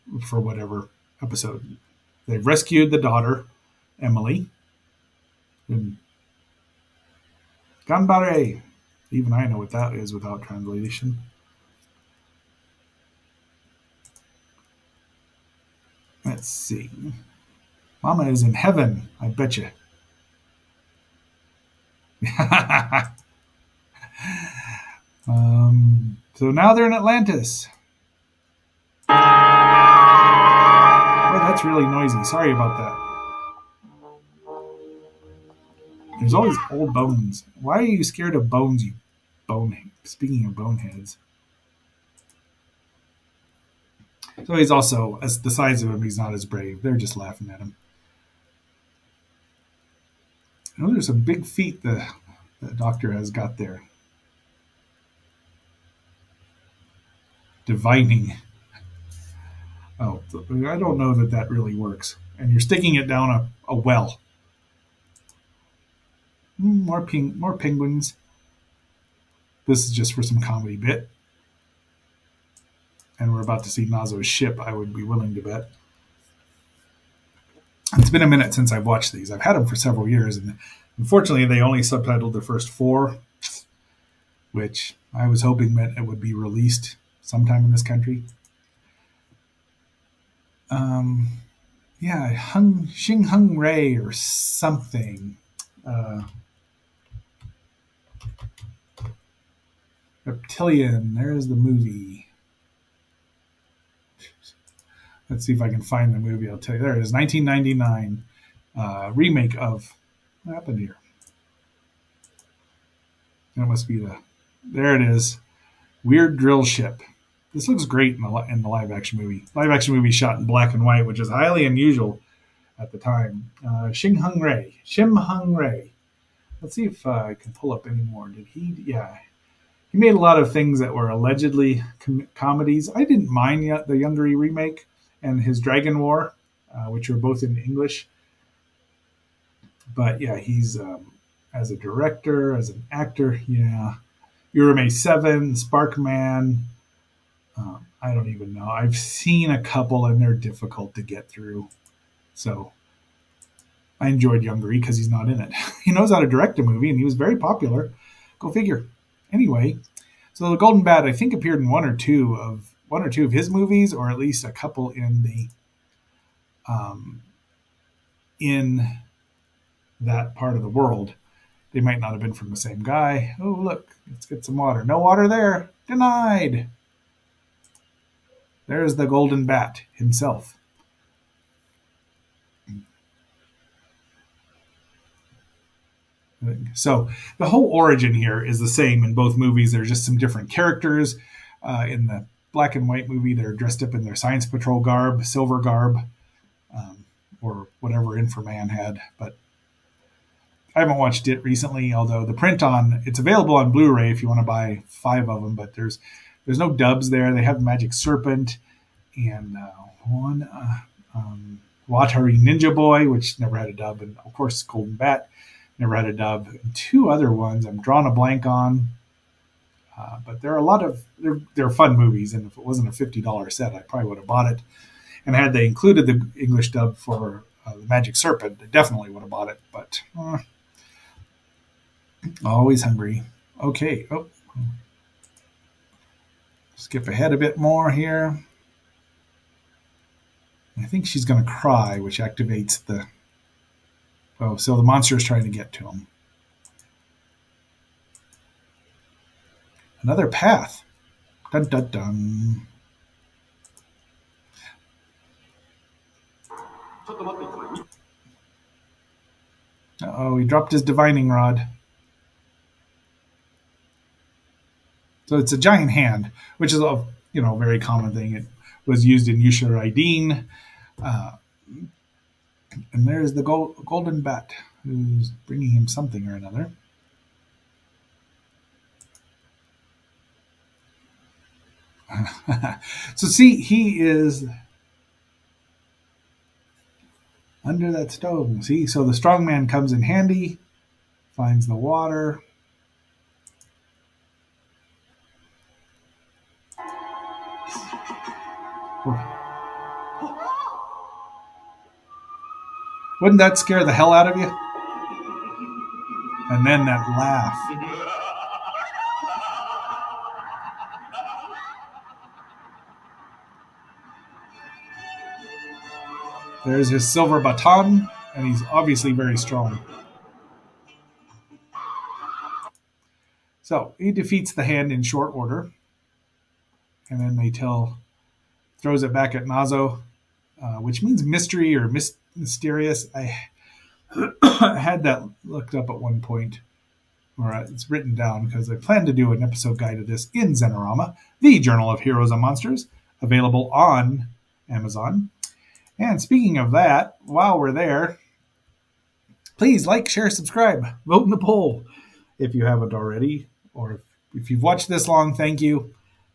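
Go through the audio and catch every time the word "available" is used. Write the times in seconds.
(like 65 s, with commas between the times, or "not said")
203 s, 343 s.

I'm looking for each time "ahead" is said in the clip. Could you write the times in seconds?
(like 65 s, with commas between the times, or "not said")
237 s.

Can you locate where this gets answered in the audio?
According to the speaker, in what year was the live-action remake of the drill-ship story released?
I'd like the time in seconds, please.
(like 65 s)
107 s.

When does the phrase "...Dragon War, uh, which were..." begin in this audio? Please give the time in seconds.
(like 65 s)
135 s.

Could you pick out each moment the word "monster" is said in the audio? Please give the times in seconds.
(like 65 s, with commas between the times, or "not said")
244 s, 342 s.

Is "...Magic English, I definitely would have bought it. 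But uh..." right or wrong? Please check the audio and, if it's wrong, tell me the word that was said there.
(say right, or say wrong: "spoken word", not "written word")
wrong: "Serpent", not "English".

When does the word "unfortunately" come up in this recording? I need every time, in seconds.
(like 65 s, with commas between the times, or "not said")
80 s.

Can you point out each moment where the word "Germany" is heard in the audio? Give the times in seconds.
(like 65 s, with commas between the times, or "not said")
not said.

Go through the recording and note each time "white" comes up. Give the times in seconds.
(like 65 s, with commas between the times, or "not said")
120 s, 192 s.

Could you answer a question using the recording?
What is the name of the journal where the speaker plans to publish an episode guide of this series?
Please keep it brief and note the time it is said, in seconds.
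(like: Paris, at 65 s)
Zenorama, at 340 s.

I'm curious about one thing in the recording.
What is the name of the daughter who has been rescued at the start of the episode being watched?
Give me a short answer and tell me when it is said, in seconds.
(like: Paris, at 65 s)
Emily, at 3 s.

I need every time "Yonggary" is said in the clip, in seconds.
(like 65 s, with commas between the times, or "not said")
133 s, 154 s.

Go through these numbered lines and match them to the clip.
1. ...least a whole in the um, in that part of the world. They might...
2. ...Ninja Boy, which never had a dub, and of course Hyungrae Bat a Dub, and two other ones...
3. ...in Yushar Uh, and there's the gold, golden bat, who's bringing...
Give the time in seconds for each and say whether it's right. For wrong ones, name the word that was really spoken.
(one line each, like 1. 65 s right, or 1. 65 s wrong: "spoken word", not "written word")
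1. 164 s wrong: "couple", not "whole"
2. 212 s wrong: "Golden", not "Hyungrae"
3. 269 s right.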